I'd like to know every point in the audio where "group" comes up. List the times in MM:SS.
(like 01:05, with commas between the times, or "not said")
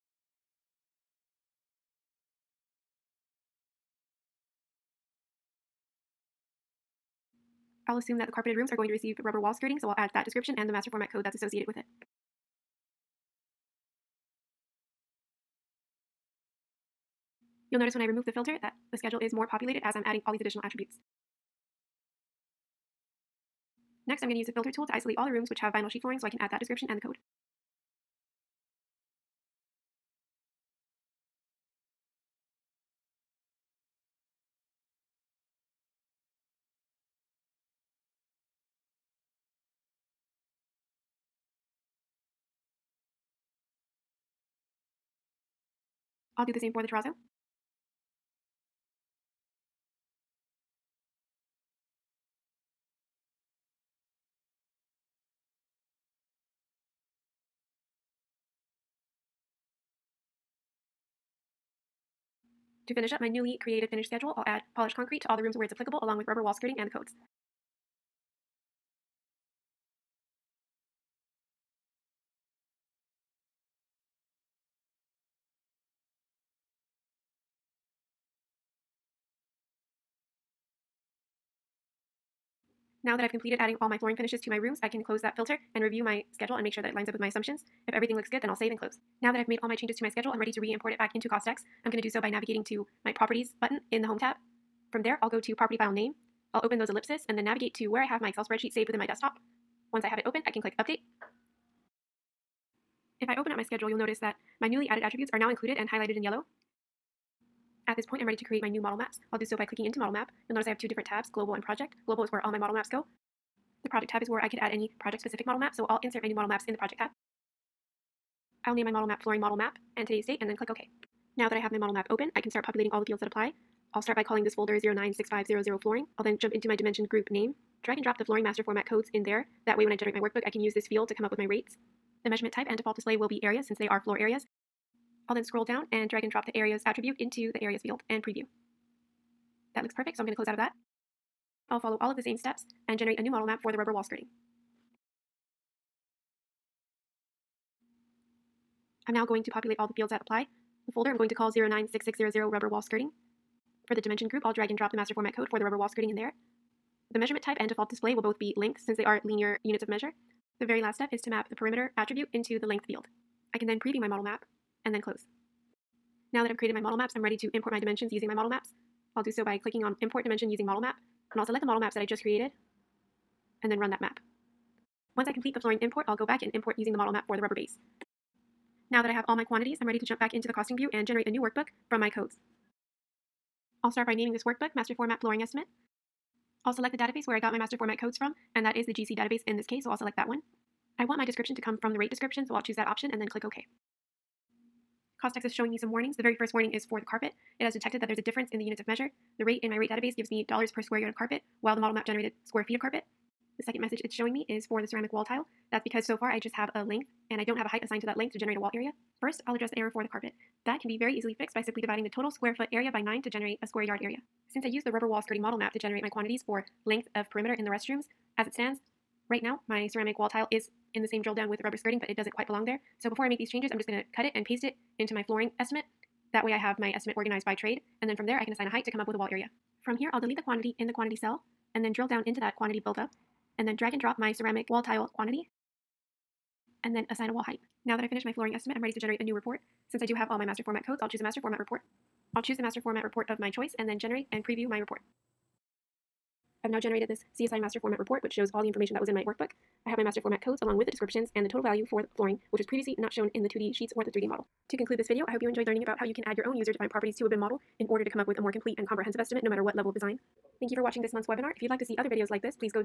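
02:07, 02:34.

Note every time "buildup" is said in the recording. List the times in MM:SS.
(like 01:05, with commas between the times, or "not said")
03:52.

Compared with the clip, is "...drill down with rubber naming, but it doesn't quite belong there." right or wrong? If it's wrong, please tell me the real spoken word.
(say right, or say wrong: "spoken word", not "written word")
wrong: "skirting", not "naming".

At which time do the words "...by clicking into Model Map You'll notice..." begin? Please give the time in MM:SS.
01:49.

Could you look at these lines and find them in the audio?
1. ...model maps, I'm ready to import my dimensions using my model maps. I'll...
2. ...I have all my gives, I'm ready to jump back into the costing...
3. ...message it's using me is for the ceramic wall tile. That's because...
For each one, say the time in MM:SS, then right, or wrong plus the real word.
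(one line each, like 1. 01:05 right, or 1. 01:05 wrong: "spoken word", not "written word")
1. 02:46 right
2. 02:59 wrong: "quantities", not "gives"
3. 03:23 wrong: "showing", not "using".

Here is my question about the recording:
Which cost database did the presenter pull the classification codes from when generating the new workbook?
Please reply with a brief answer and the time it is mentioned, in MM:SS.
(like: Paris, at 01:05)
GC database, at 03:08.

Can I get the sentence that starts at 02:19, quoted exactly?
That looks perfect, so I'm going to close out of that.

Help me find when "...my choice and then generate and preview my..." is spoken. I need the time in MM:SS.
04:03.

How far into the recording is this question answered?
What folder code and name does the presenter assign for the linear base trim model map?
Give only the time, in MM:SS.
02:31.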